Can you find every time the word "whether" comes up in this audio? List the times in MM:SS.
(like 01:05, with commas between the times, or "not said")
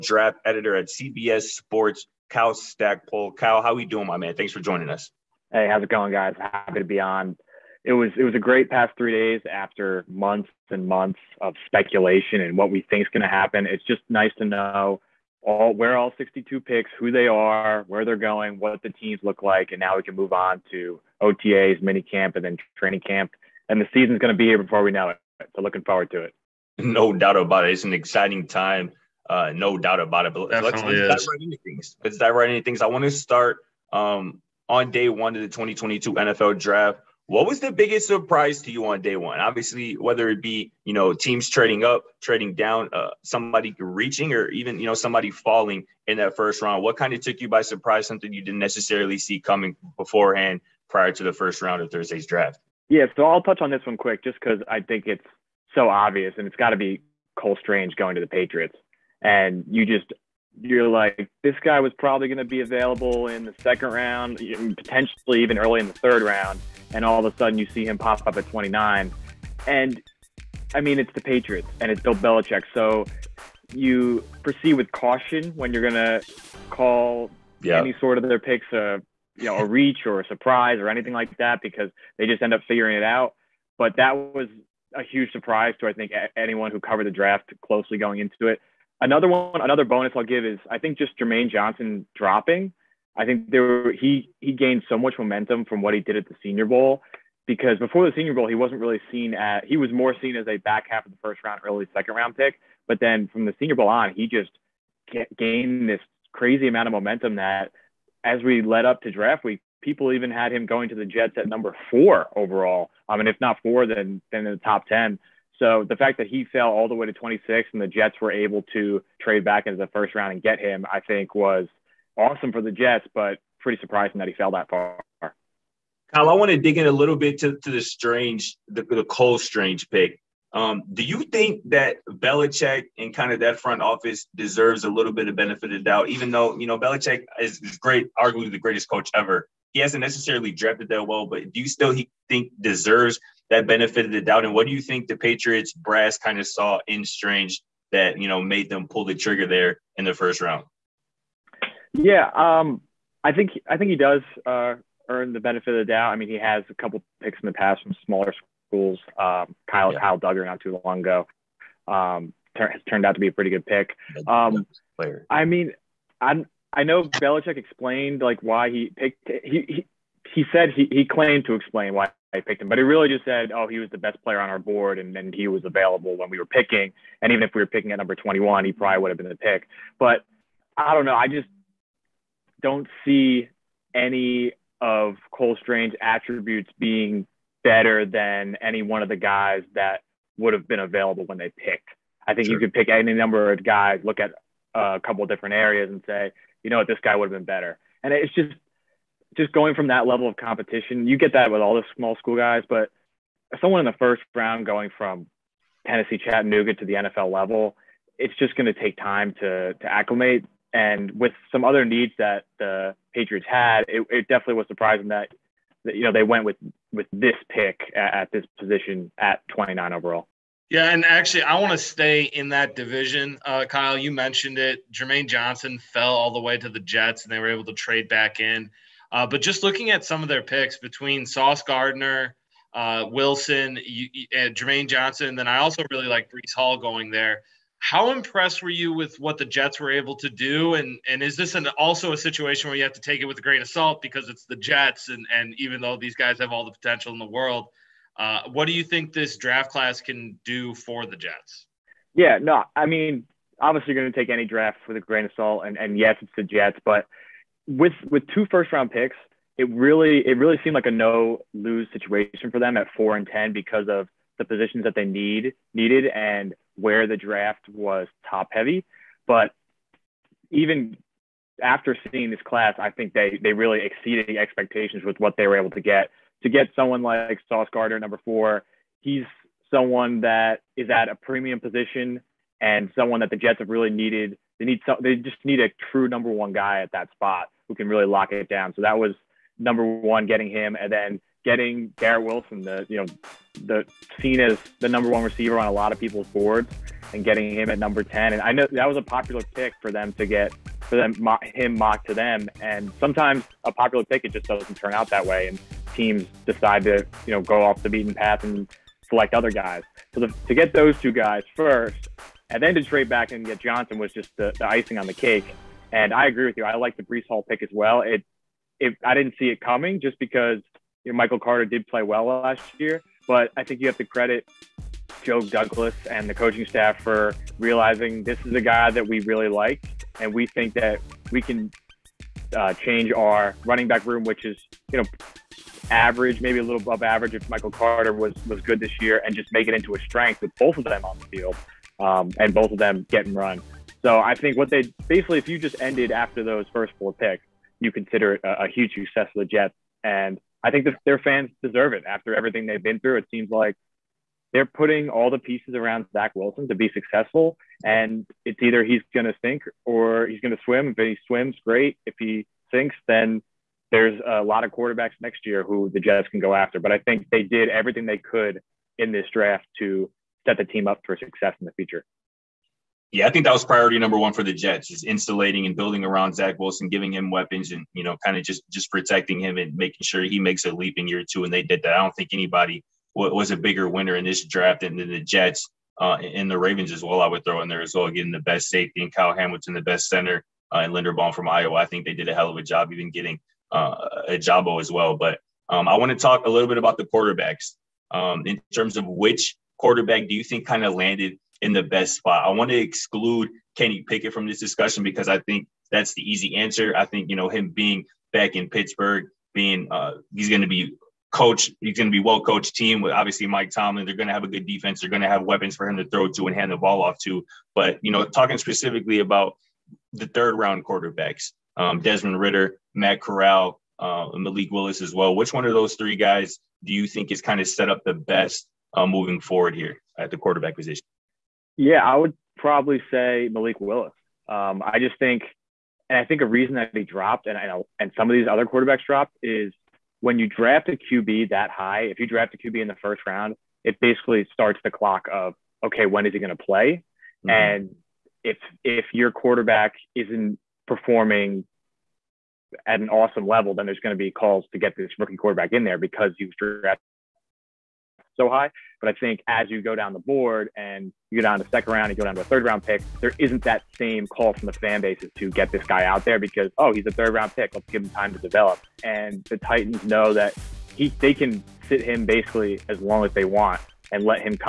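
00:39.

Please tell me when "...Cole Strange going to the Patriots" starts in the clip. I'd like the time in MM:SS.
00:57.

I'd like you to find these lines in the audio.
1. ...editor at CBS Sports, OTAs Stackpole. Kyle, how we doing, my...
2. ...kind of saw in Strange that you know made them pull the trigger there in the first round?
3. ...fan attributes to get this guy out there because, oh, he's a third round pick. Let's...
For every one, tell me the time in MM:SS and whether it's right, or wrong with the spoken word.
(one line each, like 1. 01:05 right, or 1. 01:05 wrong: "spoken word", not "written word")
1. 00:00 wrong: "Kyle", not "OTAs"
2. 02:26 right
3. 07:44 wrong: "bases", not "attributes".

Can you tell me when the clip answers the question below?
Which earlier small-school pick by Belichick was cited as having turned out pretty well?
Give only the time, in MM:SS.
02:39.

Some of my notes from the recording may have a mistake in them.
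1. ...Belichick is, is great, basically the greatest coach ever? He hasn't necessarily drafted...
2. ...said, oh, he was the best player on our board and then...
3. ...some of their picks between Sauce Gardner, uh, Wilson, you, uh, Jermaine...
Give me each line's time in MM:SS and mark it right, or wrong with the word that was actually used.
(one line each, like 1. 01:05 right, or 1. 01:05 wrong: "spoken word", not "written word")
1. 02:16 wrong: "arguably", not "basically"
2. 02:53 right
3. 03:50 right.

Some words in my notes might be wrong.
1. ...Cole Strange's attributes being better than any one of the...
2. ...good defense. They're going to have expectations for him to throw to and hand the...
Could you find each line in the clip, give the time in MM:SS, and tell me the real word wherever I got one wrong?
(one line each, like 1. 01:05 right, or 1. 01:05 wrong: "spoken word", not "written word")
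1. 03:05 right
2. 06:54 wrong: "weapons", not "expectations".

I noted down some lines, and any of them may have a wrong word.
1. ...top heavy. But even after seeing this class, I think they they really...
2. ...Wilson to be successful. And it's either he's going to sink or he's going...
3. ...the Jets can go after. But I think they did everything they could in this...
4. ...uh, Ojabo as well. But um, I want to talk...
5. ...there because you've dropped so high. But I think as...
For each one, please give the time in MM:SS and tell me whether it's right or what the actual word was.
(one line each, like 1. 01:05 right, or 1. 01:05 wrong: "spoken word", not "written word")
1. 04:28 right
2. 05:56 right
3. 06:05 right
4. 06:33 right
5. 07:35 wrong: "drafted", not "dropped".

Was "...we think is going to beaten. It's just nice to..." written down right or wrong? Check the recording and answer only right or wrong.
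wrong.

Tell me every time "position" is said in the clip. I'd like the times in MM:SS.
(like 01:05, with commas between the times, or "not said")
03:38, 04:24, 04:41, 07:10.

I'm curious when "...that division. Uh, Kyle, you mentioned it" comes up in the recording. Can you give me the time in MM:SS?
03:42.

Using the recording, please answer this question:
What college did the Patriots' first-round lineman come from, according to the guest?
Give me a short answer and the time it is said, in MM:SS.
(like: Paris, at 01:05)
Tennessee Chattanooga, at 03:25.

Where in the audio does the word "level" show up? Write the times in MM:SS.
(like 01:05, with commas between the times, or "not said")
03:20, 03:27, 07:33.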